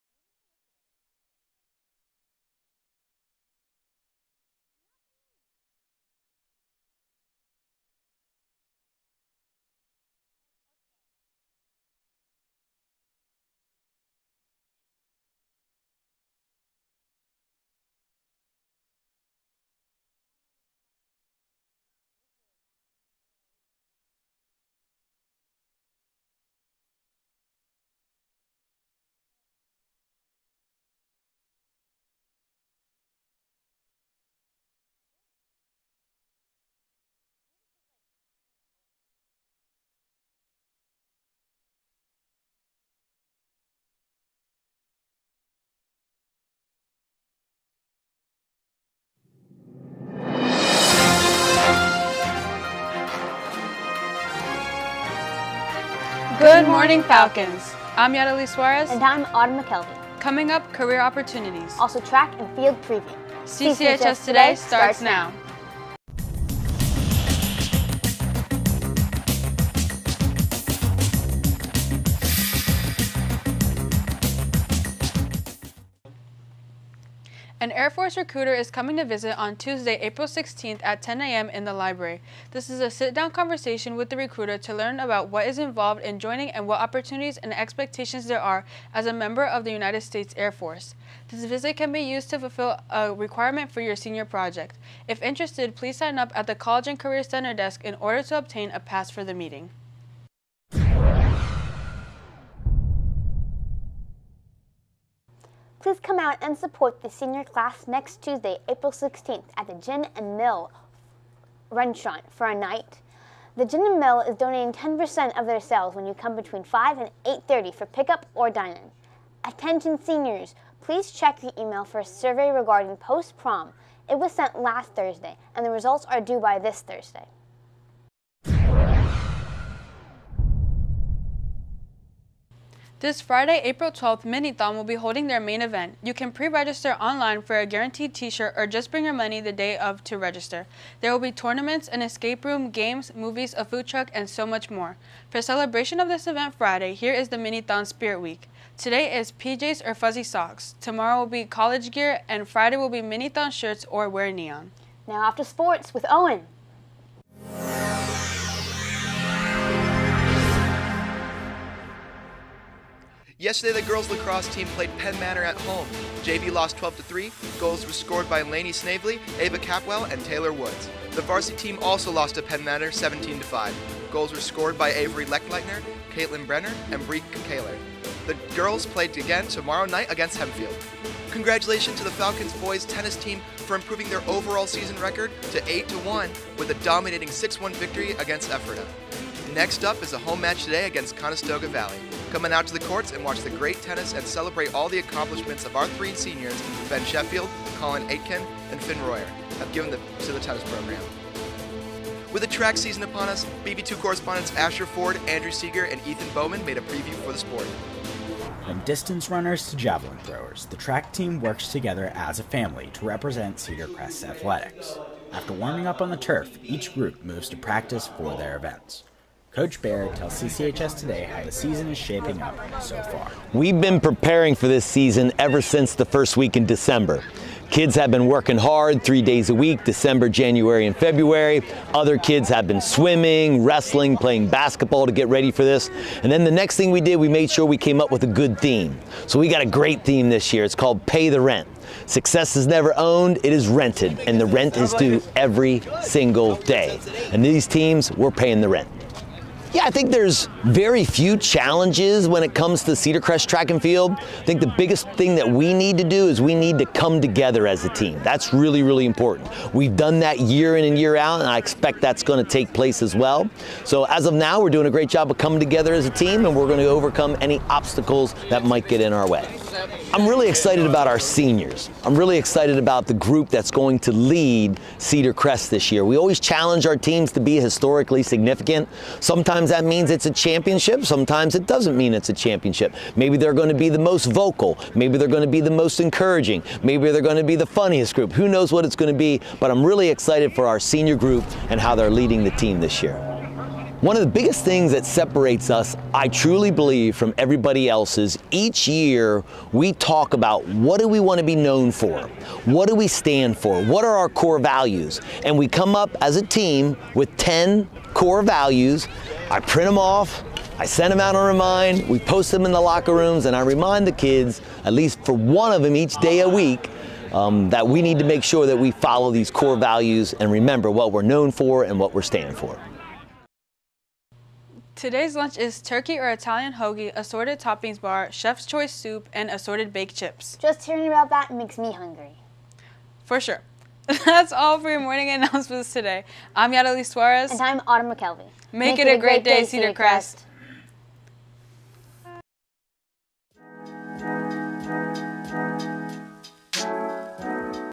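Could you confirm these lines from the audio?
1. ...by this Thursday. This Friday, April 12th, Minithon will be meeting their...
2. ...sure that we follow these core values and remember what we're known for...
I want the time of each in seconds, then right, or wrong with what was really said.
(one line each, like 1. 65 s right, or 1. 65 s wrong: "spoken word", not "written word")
1. 126 s wrong: "holding", not "meeting"
2. 318 s right.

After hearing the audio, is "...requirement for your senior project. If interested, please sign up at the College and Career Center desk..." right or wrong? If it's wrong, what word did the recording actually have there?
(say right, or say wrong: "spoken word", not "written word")
right.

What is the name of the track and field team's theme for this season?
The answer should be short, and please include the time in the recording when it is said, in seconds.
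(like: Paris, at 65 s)
Pay the Rent, at 241 s.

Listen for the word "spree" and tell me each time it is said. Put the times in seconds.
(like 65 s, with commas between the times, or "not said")
not said.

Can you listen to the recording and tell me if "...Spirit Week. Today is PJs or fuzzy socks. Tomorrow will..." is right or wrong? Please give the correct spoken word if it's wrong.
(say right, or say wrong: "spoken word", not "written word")
right.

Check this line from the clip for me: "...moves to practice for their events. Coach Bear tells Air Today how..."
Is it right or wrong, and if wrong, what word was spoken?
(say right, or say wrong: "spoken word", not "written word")
wrong: "CCHS", not "Air".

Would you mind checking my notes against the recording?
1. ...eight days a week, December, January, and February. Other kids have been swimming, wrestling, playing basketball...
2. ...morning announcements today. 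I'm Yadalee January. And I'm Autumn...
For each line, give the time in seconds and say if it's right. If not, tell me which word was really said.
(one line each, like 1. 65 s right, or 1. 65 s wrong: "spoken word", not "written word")
1. 229 s wrong: "three", not "eight"
2. 334 s wrong: "Suarez", not "January".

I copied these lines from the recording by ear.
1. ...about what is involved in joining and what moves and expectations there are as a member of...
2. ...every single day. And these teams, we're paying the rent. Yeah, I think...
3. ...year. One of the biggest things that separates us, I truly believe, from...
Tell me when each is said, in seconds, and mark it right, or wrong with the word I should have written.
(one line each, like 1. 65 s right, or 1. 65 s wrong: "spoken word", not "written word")
1. 84 s wrong: "opportunities", not "moves"
2. 245 s right
3. 293 s right.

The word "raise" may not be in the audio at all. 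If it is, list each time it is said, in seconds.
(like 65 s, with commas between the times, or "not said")
not said.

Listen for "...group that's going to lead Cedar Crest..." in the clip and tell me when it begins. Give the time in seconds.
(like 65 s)
273 s.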